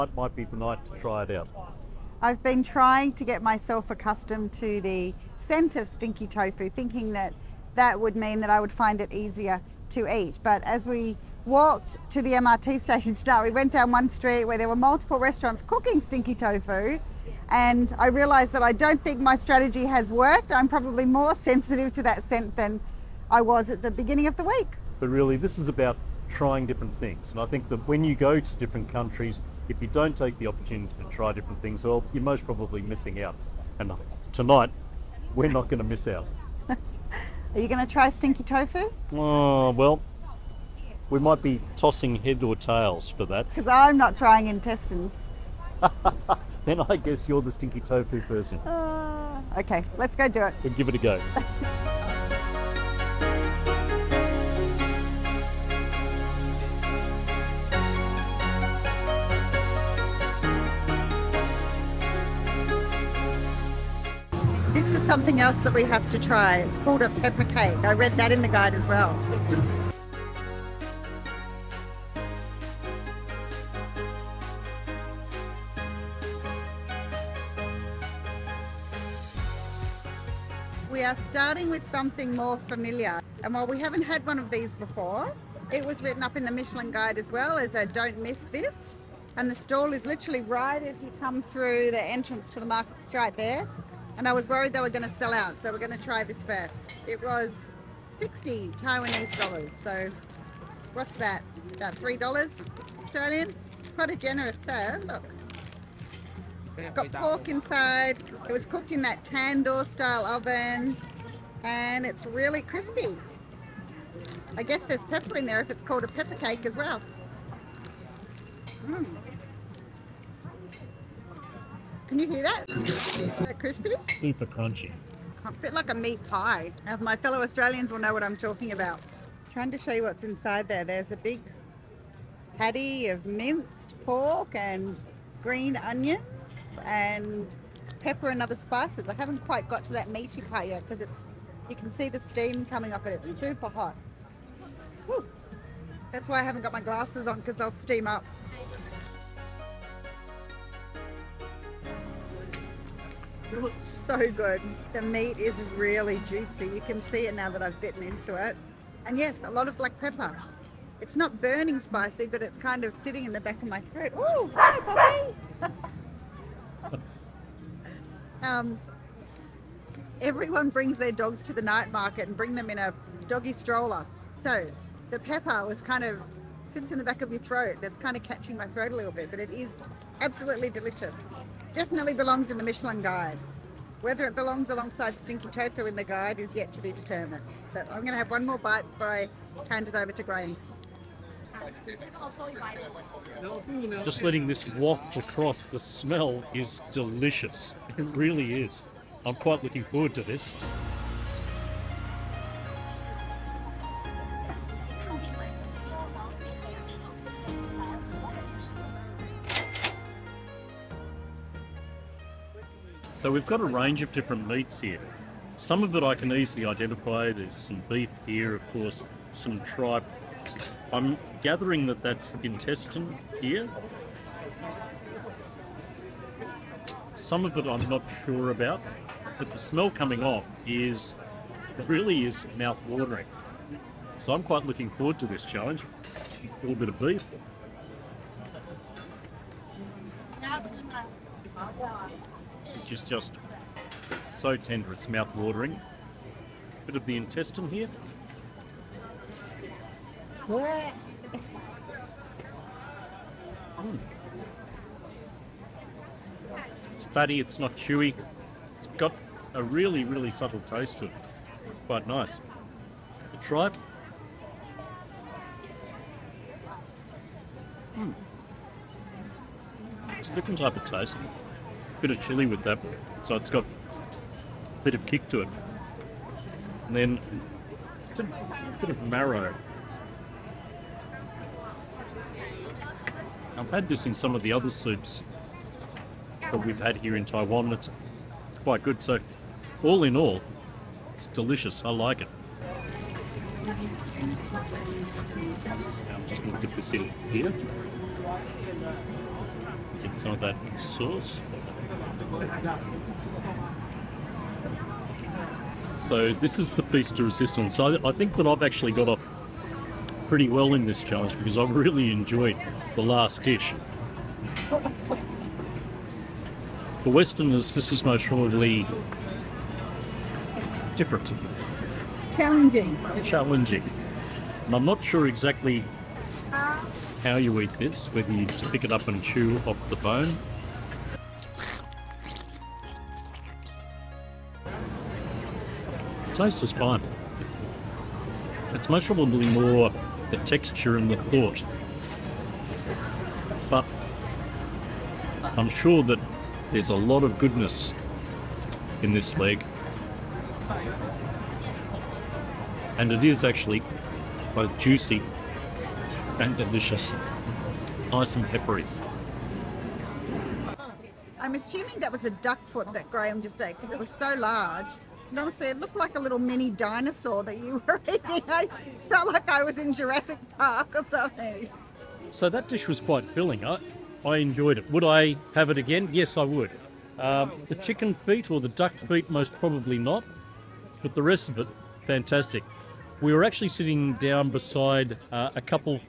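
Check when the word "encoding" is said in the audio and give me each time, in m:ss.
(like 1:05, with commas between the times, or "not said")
not said.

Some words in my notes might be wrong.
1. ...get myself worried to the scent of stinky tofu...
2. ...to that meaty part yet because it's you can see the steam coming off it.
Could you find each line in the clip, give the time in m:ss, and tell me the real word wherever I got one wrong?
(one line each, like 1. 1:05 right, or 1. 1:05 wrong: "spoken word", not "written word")
1. 0:03 wrong: "accustomed", not "worried"
2. 2:19 right.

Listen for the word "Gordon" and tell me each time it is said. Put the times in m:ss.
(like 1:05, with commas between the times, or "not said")
not said.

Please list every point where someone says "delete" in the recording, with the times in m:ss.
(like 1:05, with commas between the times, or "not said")
not said.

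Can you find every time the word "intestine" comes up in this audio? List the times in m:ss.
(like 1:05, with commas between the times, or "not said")
0:44, 3:42, 4:07.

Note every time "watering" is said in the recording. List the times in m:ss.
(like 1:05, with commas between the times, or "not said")
3:52, 4:05.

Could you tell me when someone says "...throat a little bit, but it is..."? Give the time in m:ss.
2:58.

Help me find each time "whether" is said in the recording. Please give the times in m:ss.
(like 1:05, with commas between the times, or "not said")
3:04, 5:28.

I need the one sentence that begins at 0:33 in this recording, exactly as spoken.
And tonight, we're not going to miss out.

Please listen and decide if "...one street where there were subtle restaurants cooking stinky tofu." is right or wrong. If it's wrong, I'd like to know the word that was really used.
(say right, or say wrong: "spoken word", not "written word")
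wrong: "multiple", not "subtle".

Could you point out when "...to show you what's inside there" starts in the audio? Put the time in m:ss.
2:09.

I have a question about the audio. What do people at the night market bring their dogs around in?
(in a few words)
Doggy stroller.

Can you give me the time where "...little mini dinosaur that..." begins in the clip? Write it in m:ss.
6:06.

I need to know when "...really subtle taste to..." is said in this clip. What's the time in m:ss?
4:20.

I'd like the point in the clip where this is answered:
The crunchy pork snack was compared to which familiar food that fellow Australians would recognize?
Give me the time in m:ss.
2:05.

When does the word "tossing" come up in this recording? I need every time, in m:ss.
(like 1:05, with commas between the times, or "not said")
0:41.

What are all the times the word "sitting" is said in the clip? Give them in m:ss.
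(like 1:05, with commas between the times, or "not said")
2:42, 6:23.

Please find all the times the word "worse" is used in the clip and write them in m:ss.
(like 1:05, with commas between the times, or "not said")
not said.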